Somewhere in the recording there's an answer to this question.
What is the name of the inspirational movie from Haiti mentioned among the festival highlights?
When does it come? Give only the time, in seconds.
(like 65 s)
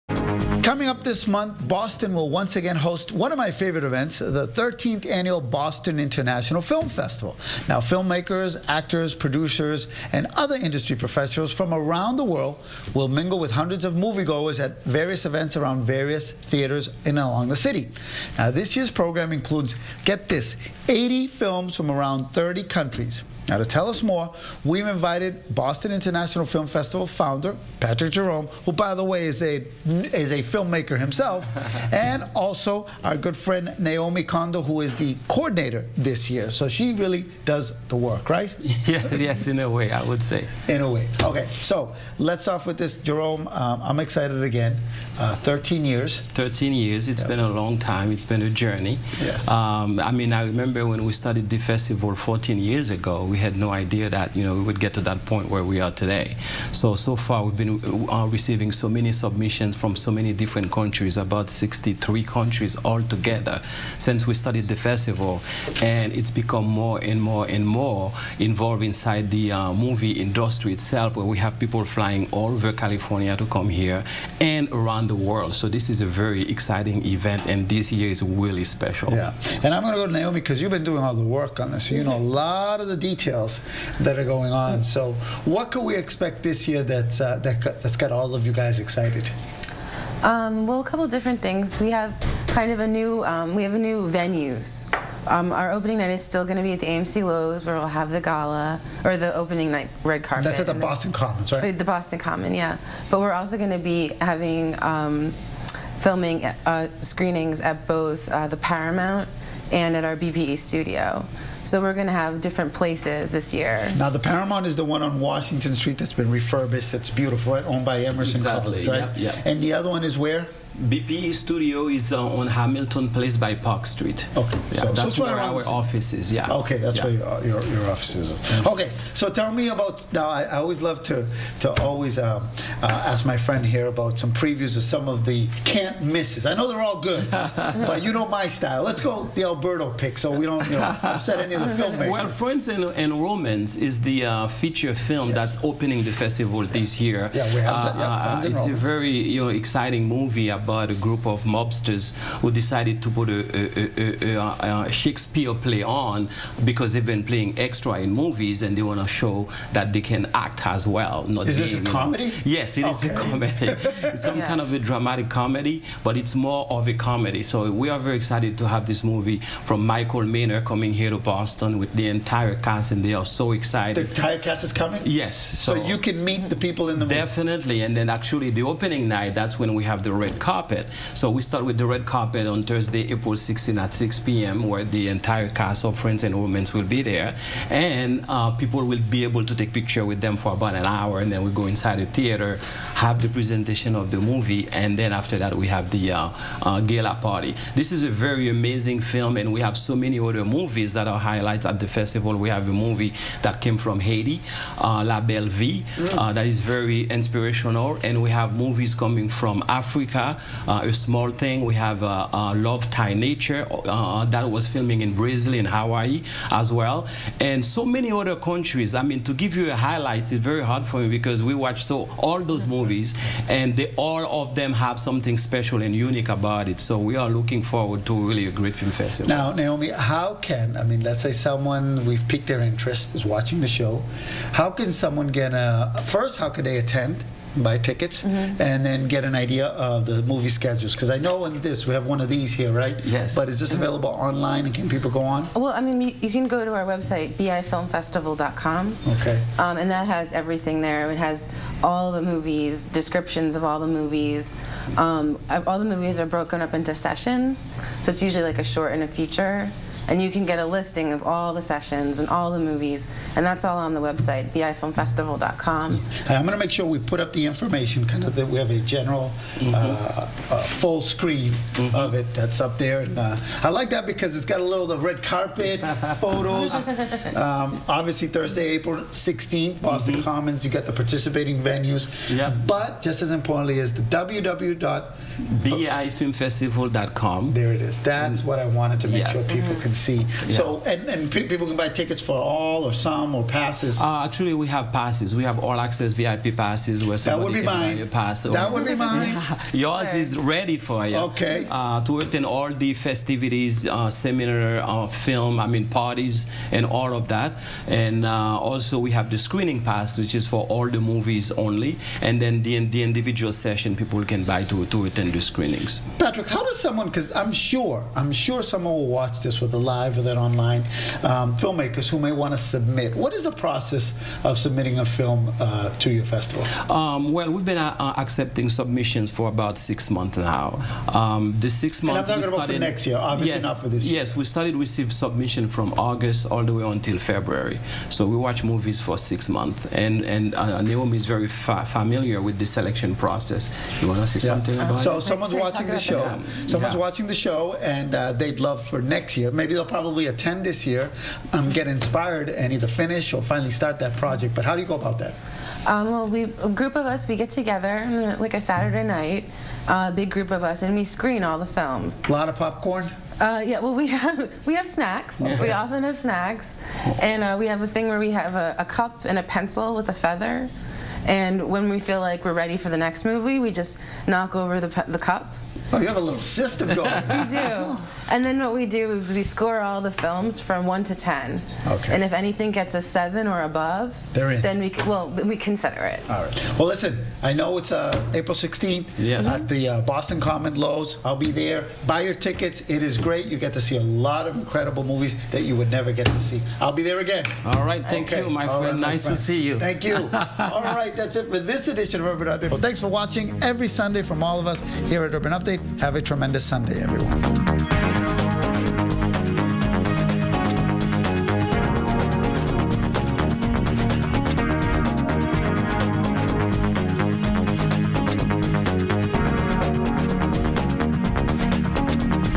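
205 s.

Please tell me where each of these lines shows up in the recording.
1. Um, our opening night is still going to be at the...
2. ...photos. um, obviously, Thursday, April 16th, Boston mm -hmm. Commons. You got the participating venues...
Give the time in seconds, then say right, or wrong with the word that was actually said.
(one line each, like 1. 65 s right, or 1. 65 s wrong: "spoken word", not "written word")
1. 95 s right
2. 276 s right.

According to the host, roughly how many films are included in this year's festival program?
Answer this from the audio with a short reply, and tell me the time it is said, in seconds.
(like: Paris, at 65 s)
80, at 20 s.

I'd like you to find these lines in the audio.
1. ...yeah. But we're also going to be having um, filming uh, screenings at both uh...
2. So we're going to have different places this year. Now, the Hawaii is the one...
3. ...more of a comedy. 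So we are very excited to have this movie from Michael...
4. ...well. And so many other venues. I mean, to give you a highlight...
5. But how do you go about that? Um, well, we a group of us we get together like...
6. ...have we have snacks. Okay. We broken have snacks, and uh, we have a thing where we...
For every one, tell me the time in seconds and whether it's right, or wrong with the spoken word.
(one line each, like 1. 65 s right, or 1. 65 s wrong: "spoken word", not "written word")
1. 102 s right
2. 111 s wrong: "Paramount", not "Hawaii"
3. 166 s right
4. 216 s wrong: "countries", not "venues"
5. 354 s right
6. 364 s wrong: "often", not "broken".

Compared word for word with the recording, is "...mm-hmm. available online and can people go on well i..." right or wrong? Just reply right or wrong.
right.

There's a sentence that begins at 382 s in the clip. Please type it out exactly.
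And if anything gets a seven or above, then we well we consider it.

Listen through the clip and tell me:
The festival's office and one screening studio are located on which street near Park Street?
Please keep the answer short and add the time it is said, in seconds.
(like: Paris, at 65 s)
Hamilton Place, at 122 s.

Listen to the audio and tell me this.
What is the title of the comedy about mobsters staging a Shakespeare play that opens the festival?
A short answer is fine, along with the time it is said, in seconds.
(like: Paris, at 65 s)
Friends and Romans, at 185 s.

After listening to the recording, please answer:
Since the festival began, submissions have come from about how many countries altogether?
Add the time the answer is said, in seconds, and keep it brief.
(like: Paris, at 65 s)
63, at 61 s.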